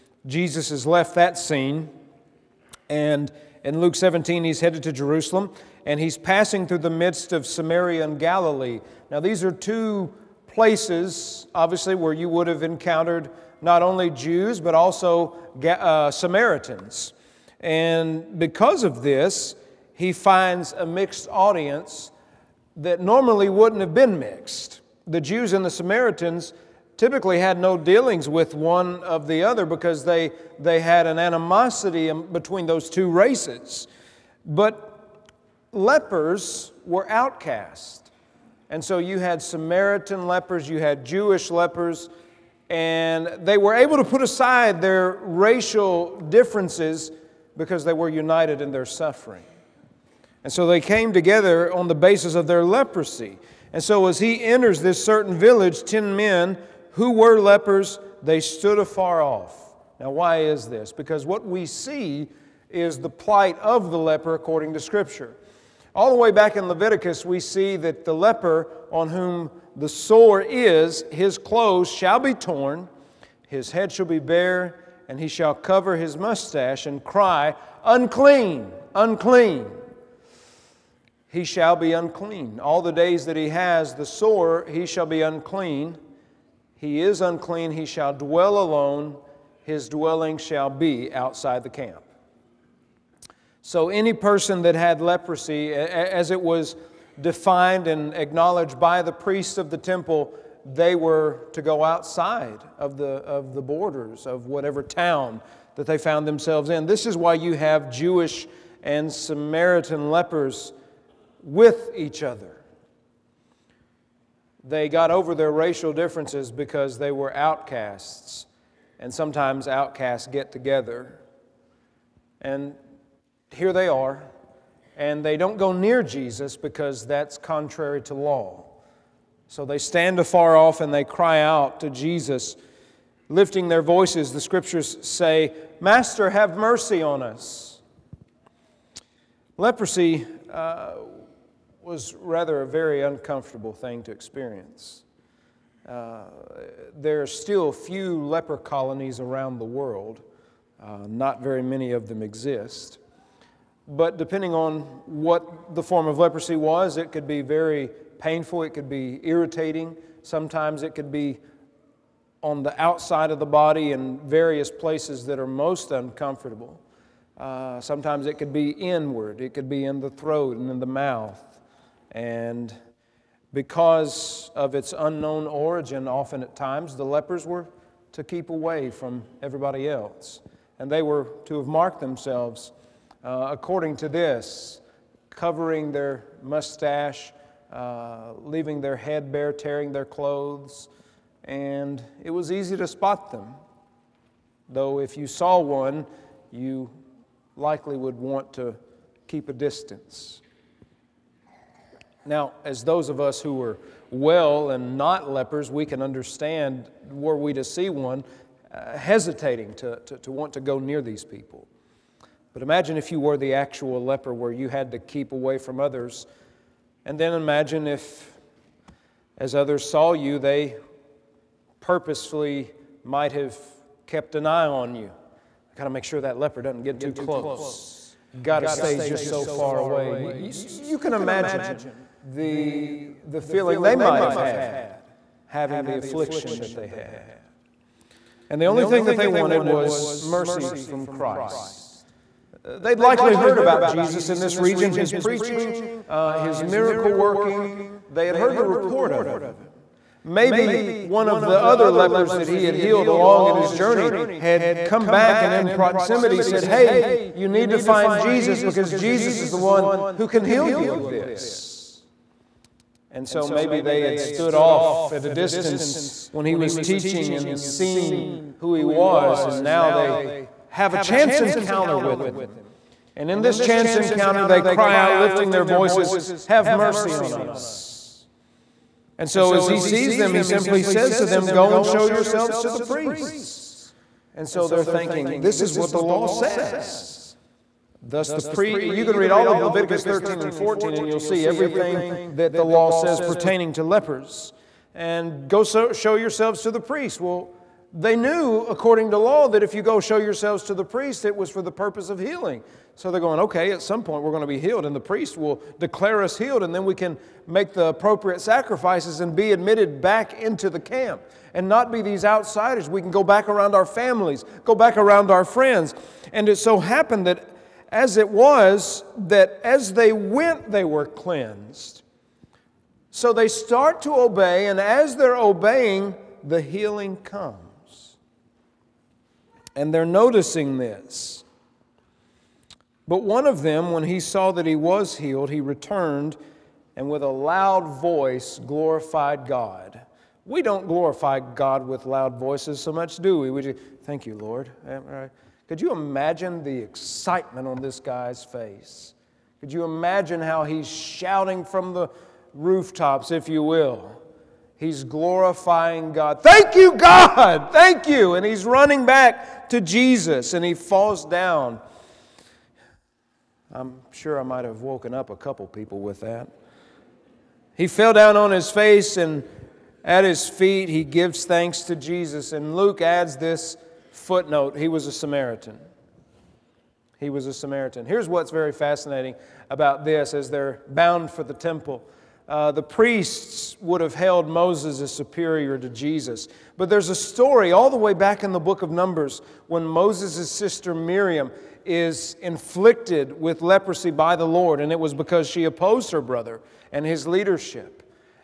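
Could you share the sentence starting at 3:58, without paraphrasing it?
And the only thing that they wanted was mercy from Christ.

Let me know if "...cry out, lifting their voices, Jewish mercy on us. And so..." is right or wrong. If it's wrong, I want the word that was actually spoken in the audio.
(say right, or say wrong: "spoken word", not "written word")
wrong: "Have", not "Jewish".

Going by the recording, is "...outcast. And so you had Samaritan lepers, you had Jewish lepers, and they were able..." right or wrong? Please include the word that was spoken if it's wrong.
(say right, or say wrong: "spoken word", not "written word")
right.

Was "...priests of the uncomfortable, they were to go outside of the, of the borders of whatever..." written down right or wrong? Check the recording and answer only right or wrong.
wrong.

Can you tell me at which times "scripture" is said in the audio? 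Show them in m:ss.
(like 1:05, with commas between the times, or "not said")
1:04, 2:14.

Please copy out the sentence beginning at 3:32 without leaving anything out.
But imagine if you were the actual leper where you had to keep away from others.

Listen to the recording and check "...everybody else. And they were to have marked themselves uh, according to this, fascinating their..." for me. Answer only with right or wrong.
wrong.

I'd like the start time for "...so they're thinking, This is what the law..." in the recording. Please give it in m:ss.
4:44.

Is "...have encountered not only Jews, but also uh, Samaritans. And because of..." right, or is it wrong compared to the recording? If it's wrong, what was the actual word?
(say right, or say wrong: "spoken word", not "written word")
right.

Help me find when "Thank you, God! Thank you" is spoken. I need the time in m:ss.
5:56.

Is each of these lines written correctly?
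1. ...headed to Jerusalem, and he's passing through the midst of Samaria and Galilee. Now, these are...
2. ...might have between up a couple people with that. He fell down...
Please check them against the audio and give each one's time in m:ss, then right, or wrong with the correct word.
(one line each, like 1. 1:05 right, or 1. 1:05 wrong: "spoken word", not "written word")
1. 0:04 right
2. 6:04 wrong: "woken", not "between".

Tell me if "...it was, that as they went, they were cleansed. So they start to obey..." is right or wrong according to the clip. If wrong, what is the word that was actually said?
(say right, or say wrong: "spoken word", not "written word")
right.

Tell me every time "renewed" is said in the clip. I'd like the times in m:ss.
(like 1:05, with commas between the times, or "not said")
not said.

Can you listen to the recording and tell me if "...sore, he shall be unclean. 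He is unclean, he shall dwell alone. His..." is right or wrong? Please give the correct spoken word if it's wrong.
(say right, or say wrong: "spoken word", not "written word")
right.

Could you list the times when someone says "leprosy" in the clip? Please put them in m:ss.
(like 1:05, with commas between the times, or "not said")
0:52, 1:34, 2:19, 2:36, 6:33.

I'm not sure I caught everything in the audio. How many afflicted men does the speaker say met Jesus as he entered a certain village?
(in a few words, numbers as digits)
10.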